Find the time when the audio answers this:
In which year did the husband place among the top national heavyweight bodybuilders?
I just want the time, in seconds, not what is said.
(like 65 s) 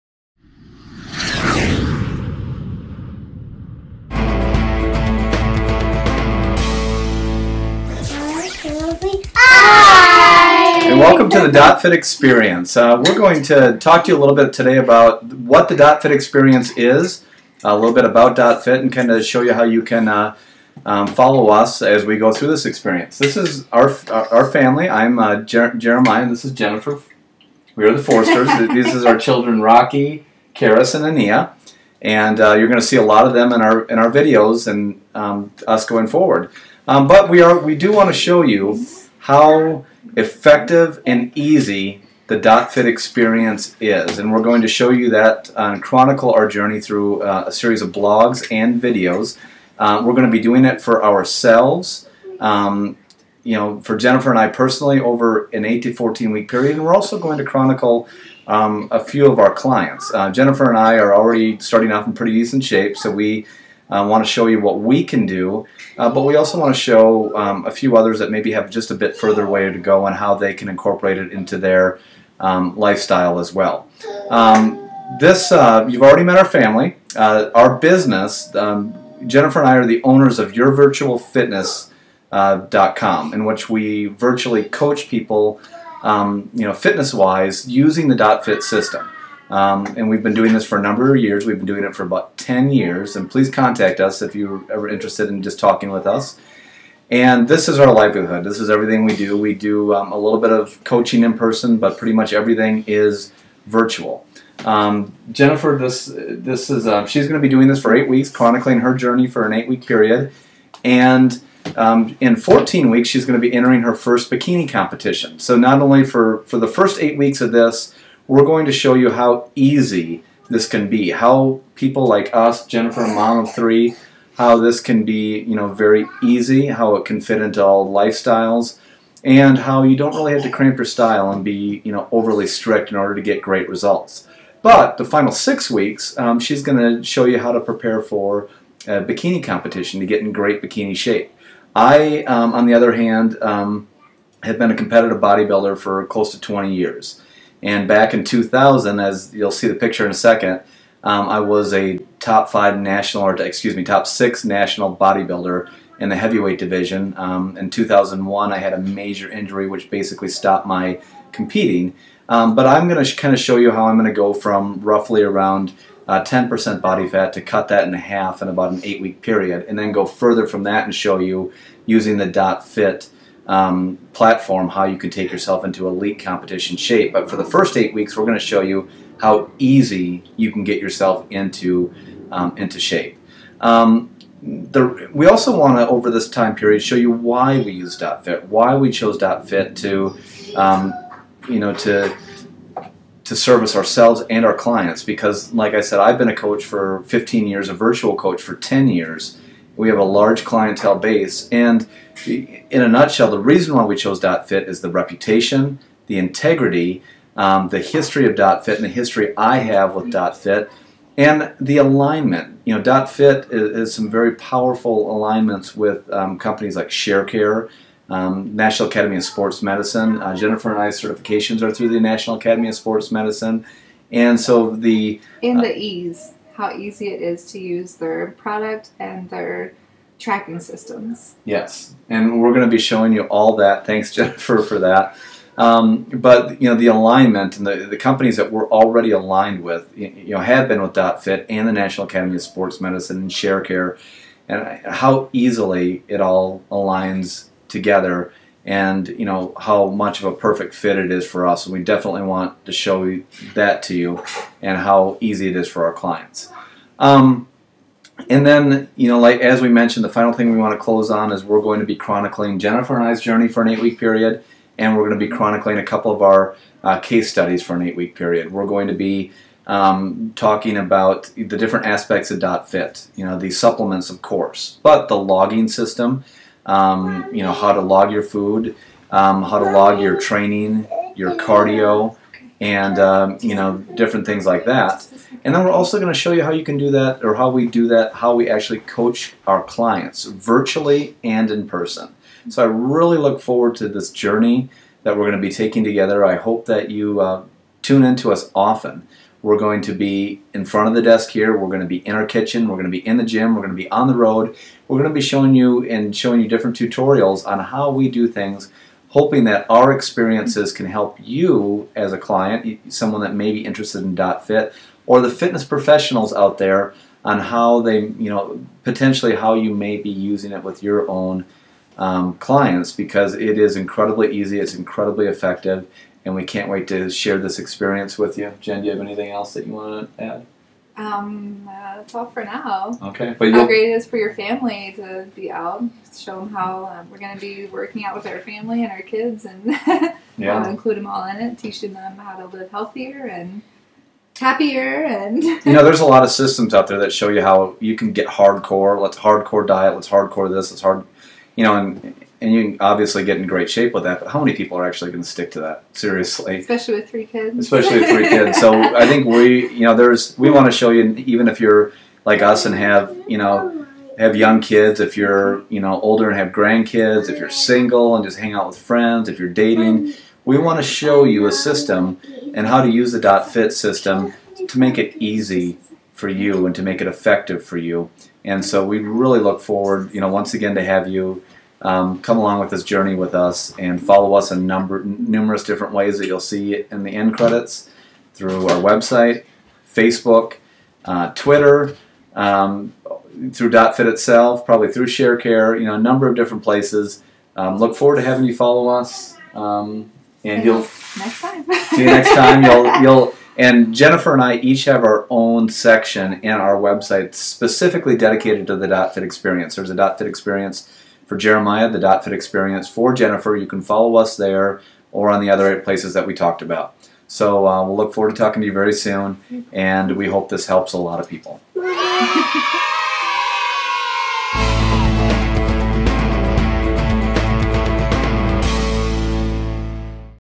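148 s.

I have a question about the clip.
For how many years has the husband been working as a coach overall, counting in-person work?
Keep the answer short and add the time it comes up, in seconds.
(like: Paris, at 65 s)
15 years, at 197 s.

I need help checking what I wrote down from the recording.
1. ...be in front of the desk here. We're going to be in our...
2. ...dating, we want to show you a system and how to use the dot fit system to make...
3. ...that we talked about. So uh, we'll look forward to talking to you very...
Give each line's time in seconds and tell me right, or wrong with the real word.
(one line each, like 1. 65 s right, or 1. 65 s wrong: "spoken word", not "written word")
1. 299 s right
2. 369 s right
3. 416 s right.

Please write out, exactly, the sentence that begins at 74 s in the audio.
Um, this, uh, you've already met our family.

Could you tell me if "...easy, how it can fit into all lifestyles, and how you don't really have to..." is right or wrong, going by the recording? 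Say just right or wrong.
right.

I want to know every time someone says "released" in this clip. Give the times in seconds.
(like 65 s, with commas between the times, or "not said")
not said.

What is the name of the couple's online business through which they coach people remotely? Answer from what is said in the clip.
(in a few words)
YourVirtualFitness.com.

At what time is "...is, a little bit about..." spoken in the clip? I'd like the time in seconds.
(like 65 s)
16 s.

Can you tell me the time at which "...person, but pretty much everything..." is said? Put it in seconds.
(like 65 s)
101 s.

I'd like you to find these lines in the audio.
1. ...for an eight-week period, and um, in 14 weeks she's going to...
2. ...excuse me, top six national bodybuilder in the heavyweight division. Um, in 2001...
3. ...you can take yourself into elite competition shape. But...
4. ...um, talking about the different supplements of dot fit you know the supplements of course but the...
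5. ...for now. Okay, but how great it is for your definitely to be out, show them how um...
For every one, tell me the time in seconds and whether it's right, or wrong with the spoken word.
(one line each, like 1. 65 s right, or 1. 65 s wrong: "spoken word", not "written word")
1. 109 s right
2. 153 s right
3. 174 s right
4. 269 s wrong: "aspects", not "supplements"
5. 332 s wrong: "family", not "definitely".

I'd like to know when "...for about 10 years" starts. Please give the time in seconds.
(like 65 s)
91 s.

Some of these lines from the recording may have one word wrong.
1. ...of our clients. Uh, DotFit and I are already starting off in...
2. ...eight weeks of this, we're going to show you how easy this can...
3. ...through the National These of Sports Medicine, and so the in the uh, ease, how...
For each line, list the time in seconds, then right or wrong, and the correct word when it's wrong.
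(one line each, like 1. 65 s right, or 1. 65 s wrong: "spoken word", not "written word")
1. 59 s wrong: "Jennifer", not "DotFit"
2. 117 s right
3. 221 s wrong: "Academy", not "These".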